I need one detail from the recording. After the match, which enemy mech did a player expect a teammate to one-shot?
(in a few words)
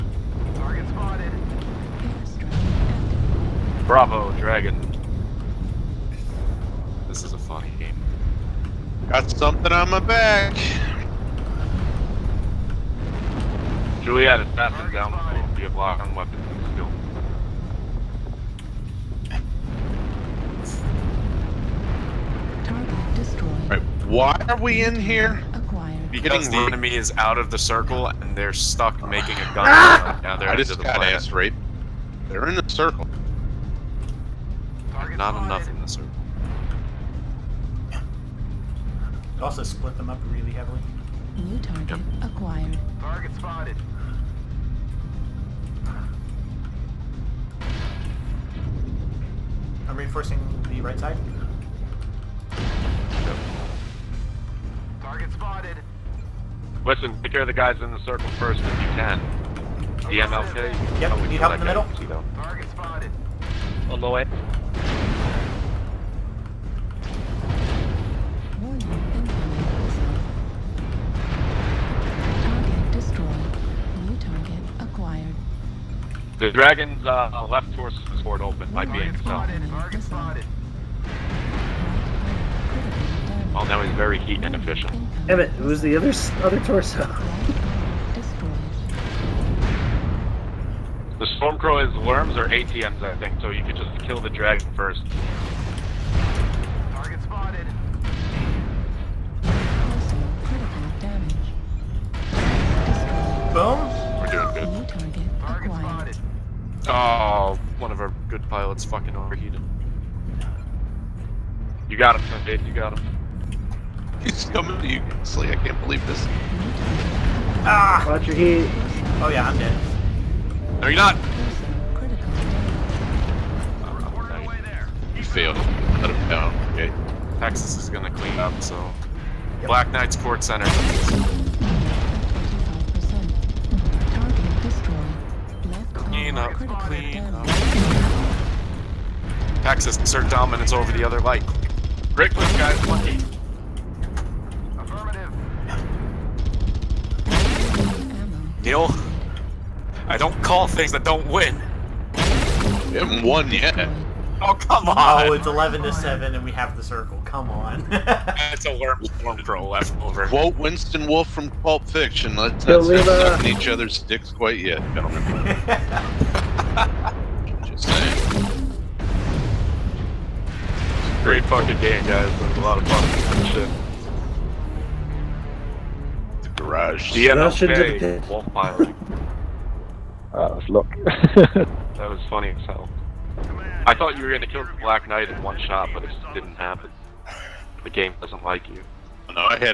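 Black Knight.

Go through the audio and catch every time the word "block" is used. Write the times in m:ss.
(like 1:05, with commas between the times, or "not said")
0:15.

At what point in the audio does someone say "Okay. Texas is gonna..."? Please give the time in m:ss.
2:06.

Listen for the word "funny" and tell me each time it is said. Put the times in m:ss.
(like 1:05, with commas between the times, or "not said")
0:07, 3:02.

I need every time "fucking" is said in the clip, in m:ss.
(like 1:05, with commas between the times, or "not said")
1:48, 2:51.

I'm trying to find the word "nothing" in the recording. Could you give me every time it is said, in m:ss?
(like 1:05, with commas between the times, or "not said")
0:14.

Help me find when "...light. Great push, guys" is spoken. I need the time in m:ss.
2:21.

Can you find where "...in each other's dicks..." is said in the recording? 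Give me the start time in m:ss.
2:43.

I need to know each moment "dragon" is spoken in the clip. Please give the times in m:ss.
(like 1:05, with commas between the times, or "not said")
0:04, 1:16, 1:34.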